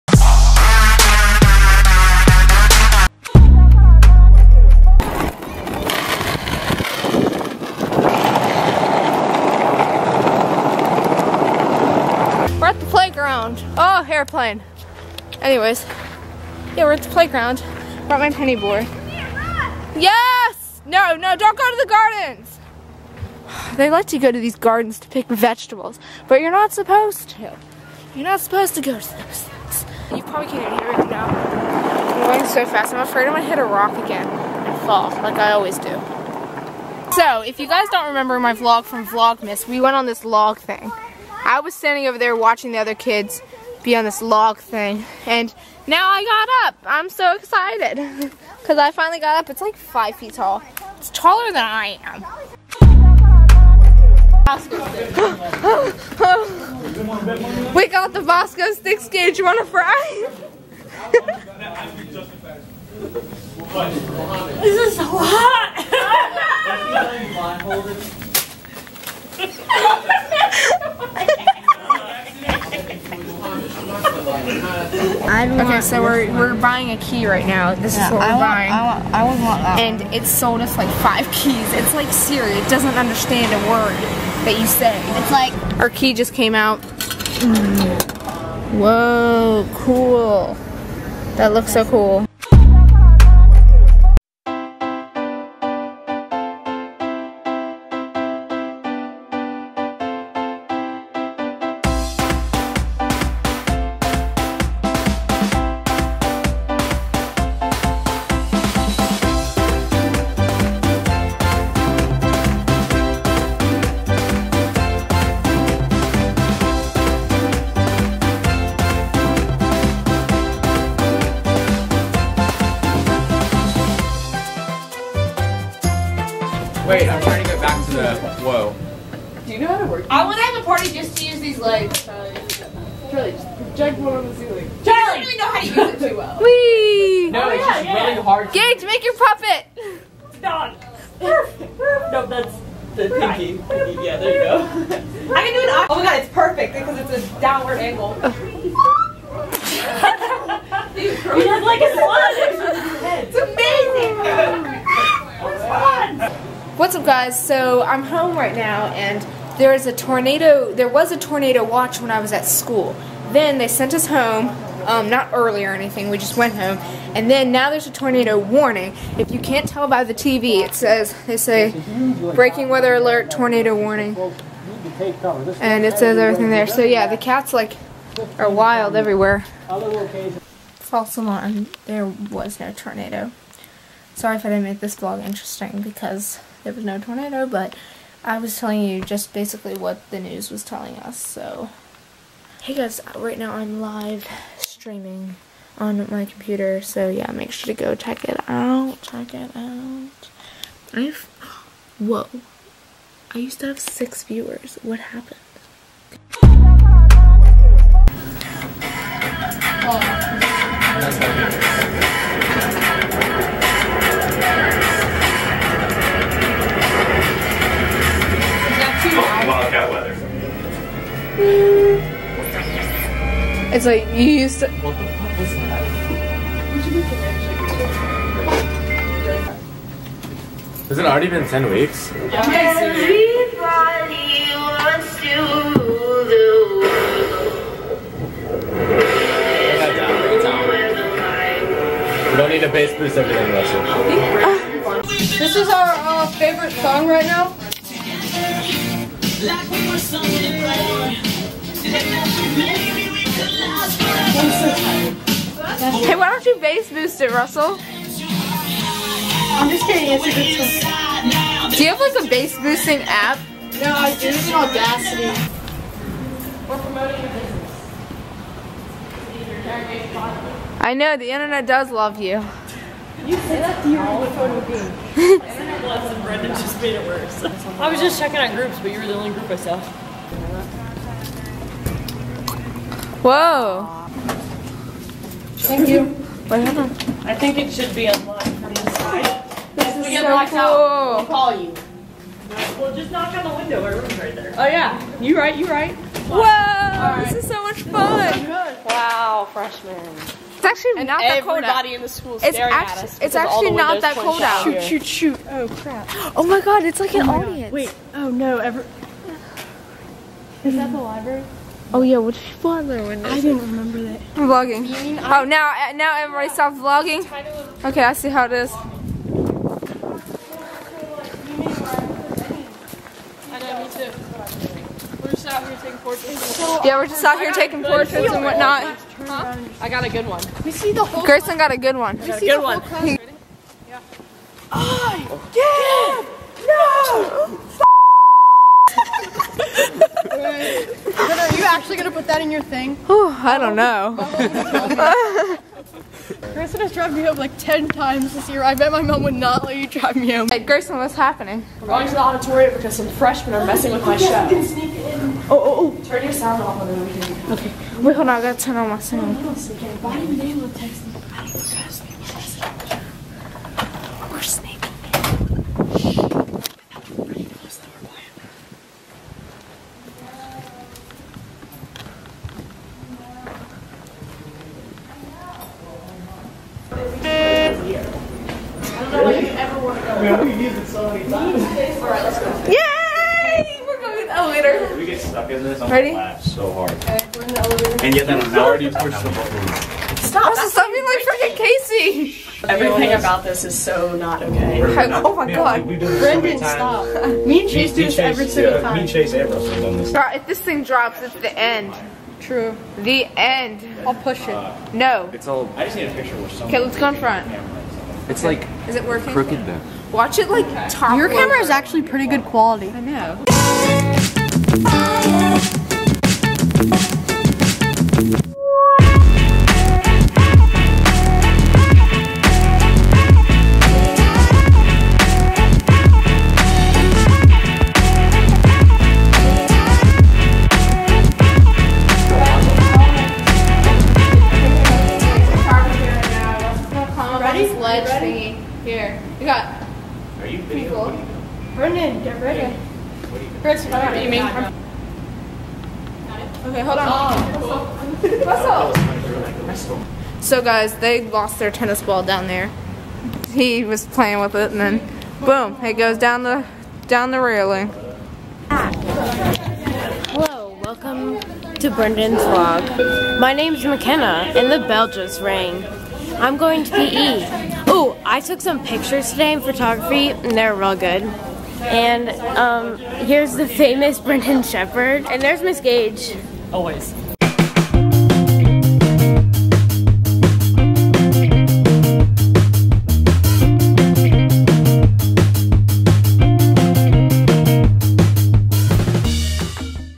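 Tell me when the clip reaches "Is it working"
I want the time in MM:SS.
06:48.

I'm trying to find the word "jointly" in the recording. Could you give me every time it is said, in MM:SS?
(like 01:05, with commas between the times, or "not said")
not said.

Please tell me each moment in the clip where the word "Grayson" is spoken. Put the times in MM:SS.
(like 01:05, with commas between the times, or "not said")
05:31, 05:46.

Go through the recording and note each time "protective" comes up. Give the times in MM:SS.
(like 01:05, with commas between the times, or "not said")
not said.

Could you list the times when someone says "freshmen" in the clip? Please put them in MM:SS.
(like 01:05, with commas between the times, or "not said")
04:59, 05:53.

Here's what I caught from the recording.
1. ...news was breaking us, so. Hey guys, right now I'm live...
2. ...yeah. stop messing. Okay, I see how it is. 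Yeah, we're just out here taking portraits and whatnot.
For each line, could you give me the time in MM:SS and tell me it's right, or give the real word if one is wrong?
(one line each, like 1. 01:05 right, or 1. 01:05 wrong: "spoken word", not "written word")
1. 03:10 wrong: "telling", not "breaking"
2. 05:16 wrong: "vlogging", not "messing".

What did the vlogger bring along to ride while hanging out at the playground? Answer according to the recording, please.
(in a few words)
Penny board.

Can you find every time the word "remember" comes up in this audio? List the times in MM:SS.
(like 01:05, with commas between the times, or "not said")
00:38, 05:13.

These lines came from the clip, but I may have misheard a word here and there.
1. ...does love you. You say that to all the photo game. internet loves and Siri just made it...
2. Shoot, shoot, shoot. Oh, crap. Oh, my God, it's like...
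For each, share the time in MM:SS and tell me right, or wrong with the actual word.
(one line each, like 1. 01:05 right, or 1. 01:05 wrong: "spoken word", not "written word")
1. 04:31 wrong: "Brendan", not "Siri"
2. 05:04 right.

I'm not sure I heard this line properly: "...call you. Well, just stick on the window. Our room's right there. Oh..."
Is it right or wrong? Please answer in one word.
wrong.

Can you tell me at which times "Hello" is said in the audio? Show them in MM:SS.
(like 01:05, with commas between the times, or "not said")
07:38.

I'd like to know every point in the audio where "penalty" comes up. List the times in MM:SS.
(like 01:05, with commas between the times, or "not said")
not said.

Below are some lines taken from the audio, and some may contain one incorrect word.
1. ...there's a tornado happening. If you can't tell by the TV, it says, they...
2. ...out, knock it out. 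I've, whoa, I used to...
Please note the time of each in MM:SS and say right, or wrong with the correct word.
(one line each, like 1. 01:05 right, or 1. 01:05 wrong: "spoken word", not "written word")
1. 02:47 wrong: "warning", not "happening"
2. 03:18 wrong: "check", not "knock".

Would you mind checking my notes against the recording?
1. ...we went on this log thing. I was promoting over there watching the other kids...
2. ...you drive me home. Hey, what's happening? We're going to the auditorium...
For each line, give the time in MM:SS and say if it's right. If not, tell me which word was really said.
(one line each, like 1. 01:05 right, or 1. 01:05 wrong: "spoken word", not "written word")
1. 00:39 wrong: "standing", not "promoting"
2. 05:49 right.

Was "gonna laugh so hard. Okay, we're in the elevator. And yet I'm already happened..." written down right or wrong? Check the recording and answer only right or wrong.
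wrong.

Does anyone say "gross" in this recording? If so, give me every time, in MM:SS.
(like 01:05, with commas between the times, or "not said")
not said.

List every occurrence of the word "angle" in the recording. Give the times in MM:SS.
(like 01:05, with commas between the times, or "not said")
02:27.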